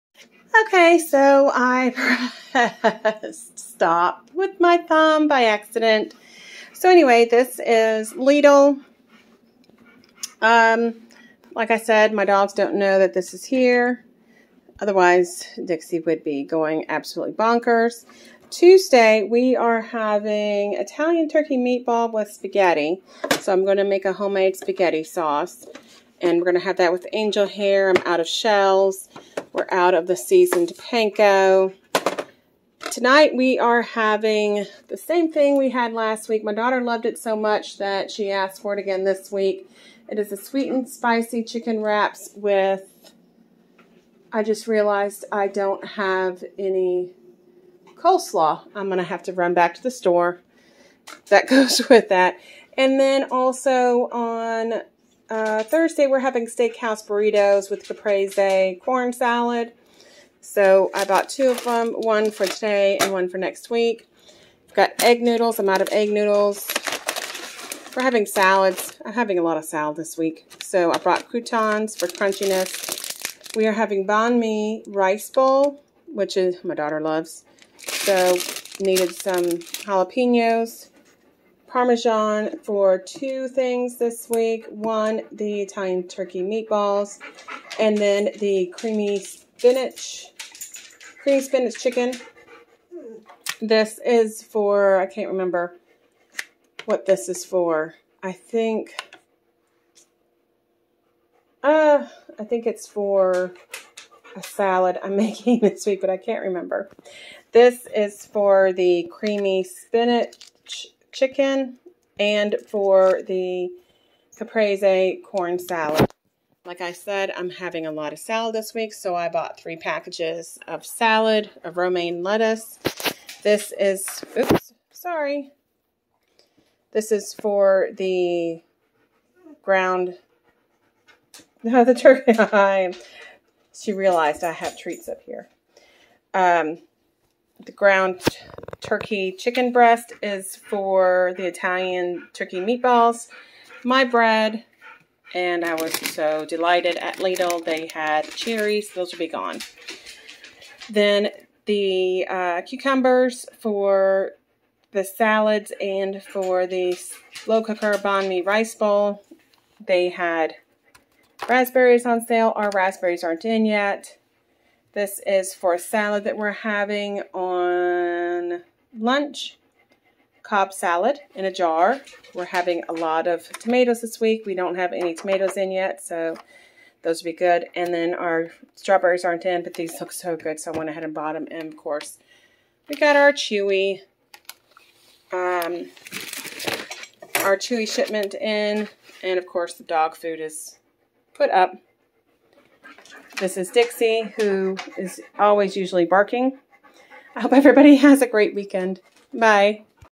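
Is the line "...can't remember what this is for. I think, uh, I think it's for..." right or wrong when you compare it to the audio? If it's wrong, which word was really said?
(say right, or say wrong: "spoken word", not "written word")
right.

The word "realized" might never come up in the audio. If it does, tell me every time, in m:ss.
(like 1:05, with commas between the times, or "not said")
0:44, 2:13.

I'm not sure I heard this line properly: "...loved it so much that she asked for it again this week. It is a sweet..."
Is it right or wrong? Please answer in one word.
right.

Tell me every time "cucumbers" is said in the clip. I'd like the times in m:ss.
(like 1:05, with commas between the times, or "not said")
2:32.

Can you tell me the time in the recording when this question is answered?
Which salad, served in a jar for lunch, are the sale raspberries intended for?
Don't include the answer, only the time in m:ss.
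2:50.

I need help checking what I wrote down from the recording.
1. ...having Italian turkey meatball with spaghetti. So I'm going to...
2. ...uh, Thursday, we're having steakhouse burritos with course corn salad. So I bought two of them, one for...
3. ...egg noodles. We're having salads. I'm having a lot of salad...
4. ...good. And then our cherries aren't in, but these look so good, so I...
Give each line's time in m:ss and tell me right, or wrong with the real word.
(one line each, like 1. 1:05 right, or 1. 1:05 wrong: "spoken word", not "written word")
1. 0:19 right
2. 0:55 wrong: "caprese", not "course"
3. 1:05 right
4. 2:57 wrong: "strawberries", not "cherries".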